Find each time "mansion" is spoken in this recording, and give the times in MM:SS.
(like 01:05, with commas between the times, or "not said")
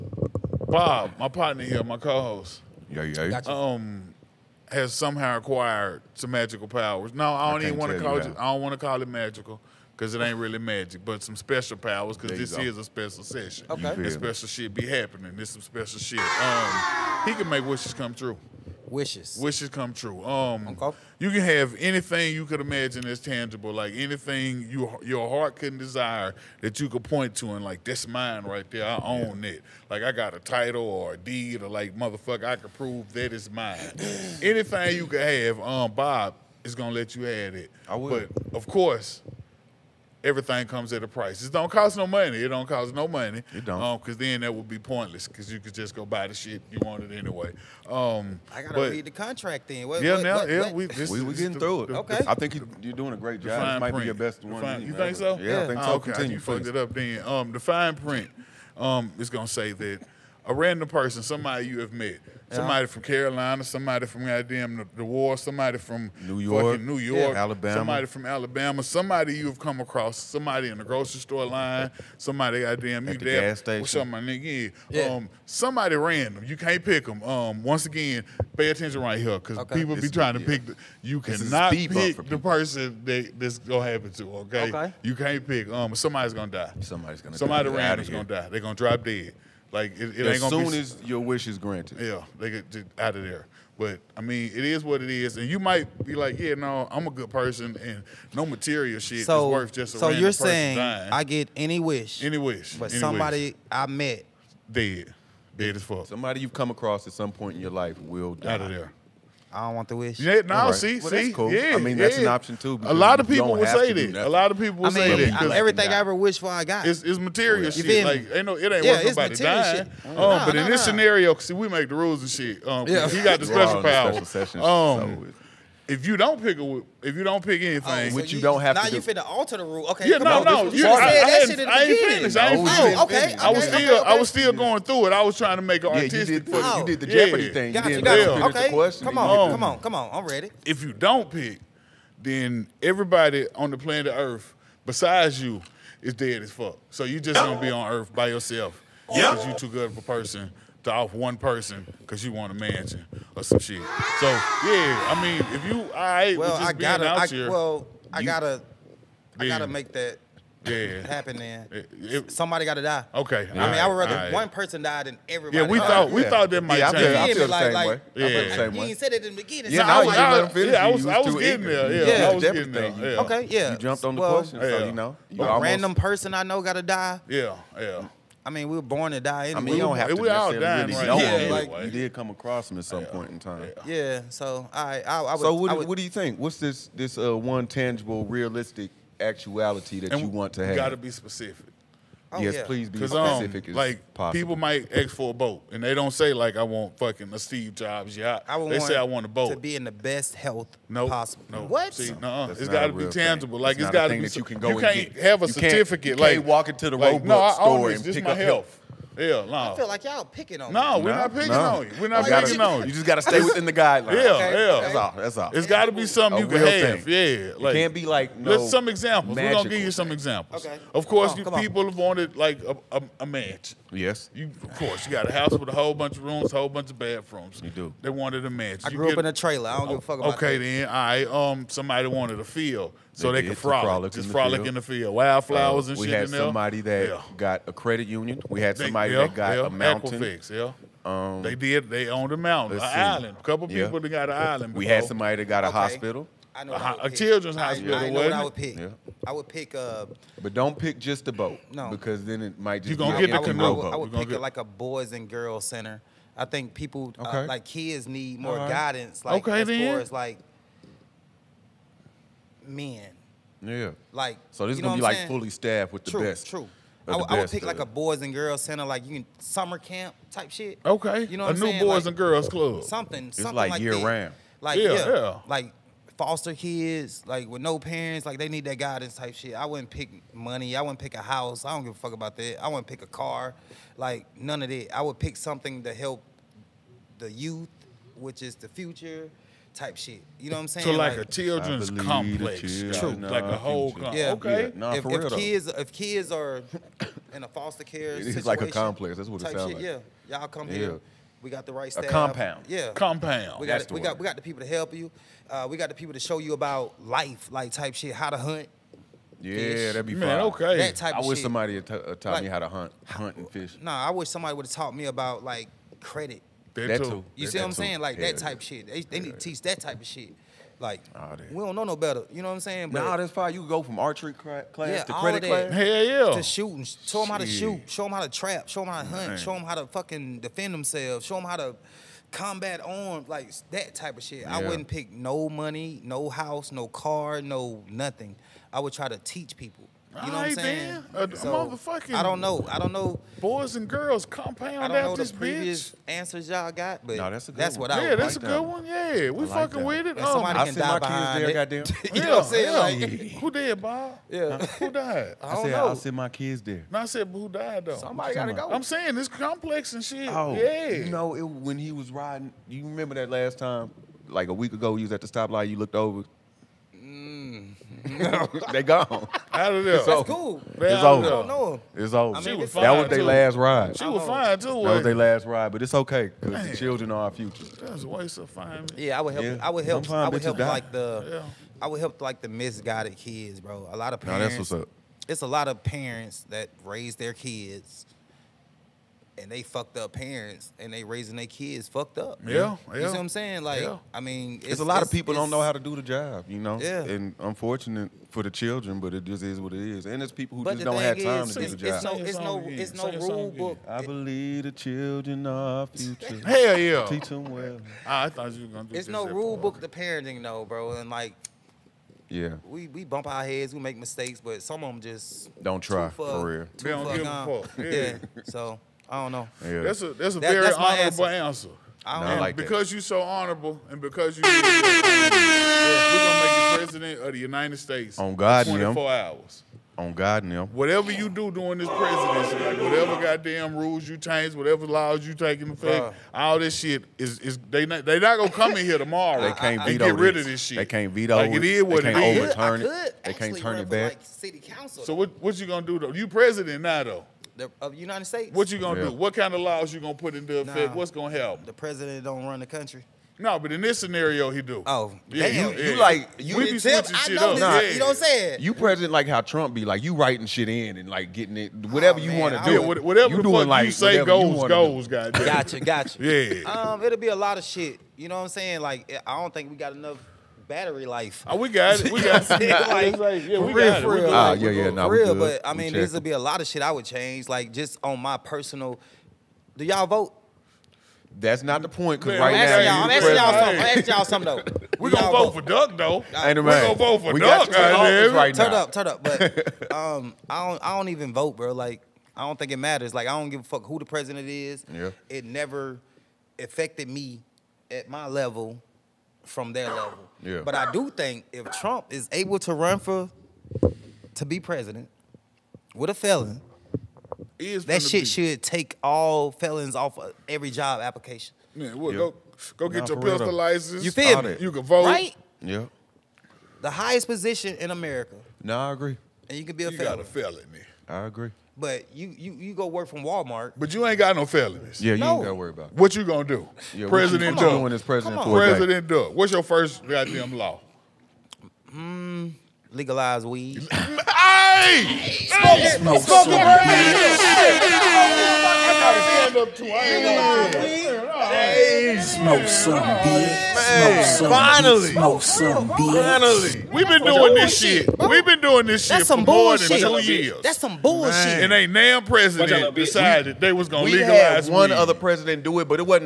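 02:32, 03:43, 03:48.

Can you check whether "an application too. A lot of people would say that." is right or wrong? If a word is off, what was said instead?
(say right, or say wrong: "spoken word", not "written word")
wrong: "option", not "application".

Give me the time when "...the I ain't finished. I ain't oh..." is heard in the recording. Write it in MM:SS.
02:11.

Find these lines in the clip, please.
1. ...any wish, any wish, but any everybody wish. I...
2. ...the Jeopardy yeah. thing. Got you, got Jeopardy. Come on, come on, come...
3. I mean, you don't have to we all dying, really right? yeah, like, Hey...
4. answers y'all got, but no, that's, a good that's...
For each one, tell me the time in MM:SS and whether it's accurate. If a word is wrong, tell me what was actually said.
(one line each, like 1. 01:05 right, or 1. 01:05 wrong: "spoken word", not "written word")
1. 01:41 wrong: "somebody", not "everybody"
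2. 02:17 wrong: "Okay", not "Jeopardy"
3. 02:59 wrong: "You", not "Hey"
4. 05:46 right.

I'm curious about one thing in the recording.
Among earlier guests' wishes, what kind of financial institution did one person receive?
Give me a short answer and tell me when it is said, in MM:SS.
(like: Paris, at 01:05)
Credit union, at 03:57.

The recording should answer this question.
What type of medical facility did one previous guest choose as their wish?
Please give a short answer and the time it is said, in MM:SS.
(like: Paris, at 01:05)
Children's hospital, at 04:07.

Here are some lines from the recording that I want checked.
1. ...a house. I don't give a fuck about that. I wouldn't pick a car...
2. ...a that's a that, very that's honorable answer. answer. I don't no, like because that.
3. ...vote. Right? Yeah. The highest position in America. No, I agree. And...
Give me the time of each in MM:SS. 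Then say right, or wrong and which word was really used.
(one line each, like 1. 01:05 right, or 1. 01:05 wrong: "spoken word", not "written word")
1. 04:41 right
2. 07:00 right
3. 08:34 right.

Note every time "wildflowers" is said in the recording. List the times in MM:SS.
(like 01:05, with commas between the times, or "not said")
03:55.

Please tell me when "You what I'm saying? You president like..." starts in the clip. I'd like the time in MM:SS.
07:37.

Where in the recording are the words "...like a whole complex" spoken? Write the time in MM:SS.
04:53.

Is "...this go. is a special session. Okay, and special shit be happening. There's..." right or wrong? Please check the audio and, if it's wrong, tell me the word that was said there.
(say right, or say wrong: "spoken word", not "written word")
right.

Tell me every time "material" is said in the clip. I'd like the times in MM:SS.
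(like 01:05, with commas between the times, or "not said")
01:38, 01:57.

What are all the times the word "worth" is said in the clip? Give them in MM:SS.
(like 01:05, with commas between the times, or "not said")
01:39, 01:59.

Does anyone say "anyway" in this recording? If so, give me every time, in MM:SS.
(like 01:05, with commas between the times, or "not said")
00:47, 02:59.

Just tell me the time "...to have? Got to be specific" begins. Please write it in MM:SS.
03:10.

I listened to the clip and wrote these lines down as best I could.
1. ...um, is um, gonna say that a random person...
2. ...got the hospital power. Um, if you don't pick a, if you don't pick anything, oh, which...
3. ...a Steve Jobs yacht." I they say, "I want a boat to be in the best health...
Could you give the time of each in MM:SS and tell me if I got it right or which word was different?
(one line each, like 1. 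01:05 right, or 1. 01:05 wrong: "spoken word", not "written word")
1. 00:58 right
2. 02:03 wrong: "special", not "hospital"
3. 03:17 right.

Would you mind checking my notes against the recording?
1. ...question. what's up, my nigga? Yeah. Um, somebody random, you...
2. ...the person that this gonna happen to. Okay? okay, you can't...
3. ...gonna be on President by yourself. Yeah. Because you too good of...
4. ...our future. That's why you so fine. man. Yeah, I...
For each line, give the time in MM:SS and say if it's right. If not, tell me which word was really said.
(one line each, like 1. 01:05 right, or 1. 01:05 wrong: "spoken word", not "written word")
1. 01:13 wrong: "station", not "question"
2. 01:22 right
3. 02:27 wrong: "Earth", not "President"
4. 06:17 right.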